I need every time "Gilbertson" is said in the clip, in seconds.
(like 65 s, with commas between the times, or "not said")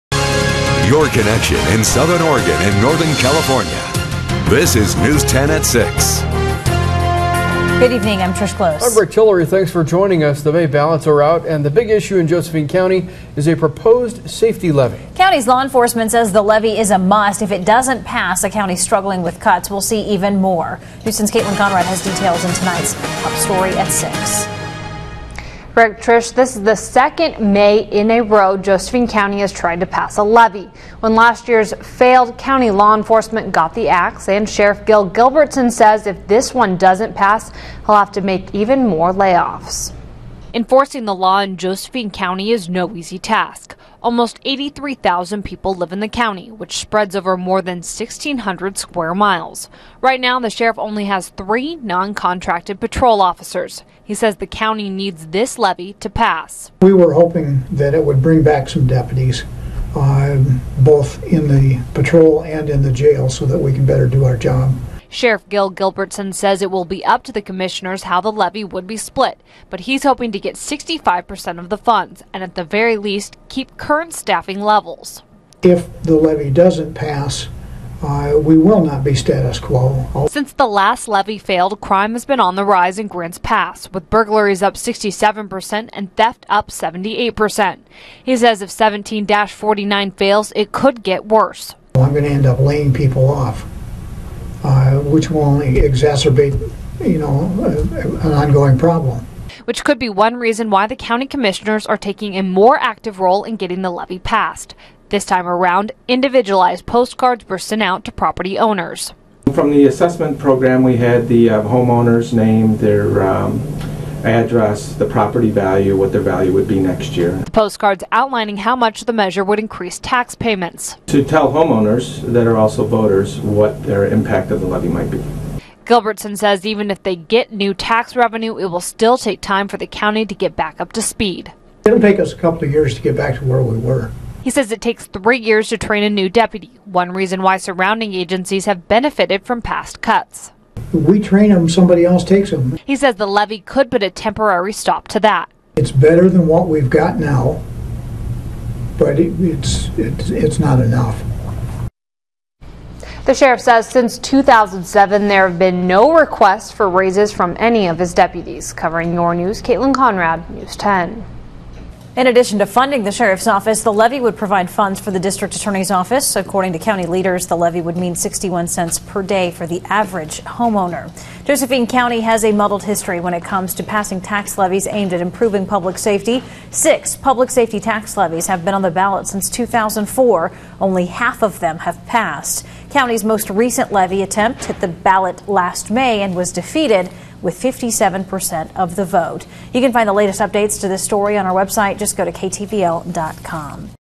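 35 s, 65 s, 125 s.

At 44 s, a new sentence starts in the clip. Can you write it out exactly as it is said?
Almost 83,000 people live in the county, which spreads over more than 1,600 square miles.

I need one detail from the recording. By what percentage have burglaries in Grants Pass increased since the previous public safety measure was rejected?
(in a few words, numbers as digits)
67%.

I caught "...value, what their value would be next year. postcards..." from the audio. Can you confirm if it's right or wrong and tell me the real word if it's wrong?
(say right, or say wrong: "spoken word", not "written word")
right.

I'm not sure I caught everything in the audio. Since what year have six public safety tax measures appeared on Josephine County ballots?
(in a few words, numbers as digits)
2004.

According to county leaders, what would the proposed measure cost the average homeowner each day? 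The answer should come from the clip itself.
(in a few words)
61 cents.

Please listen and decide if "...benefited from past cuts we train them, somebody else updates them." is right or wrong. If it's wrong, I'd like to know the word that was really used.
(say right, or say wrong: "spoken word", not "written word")
wrong: "takes", not "updates".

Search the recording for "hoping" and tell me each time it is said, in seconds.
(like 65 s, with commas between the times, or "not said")
57 s, 70 s.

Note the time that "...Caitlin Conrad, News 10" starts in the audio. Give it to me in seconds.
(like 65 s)
159 s.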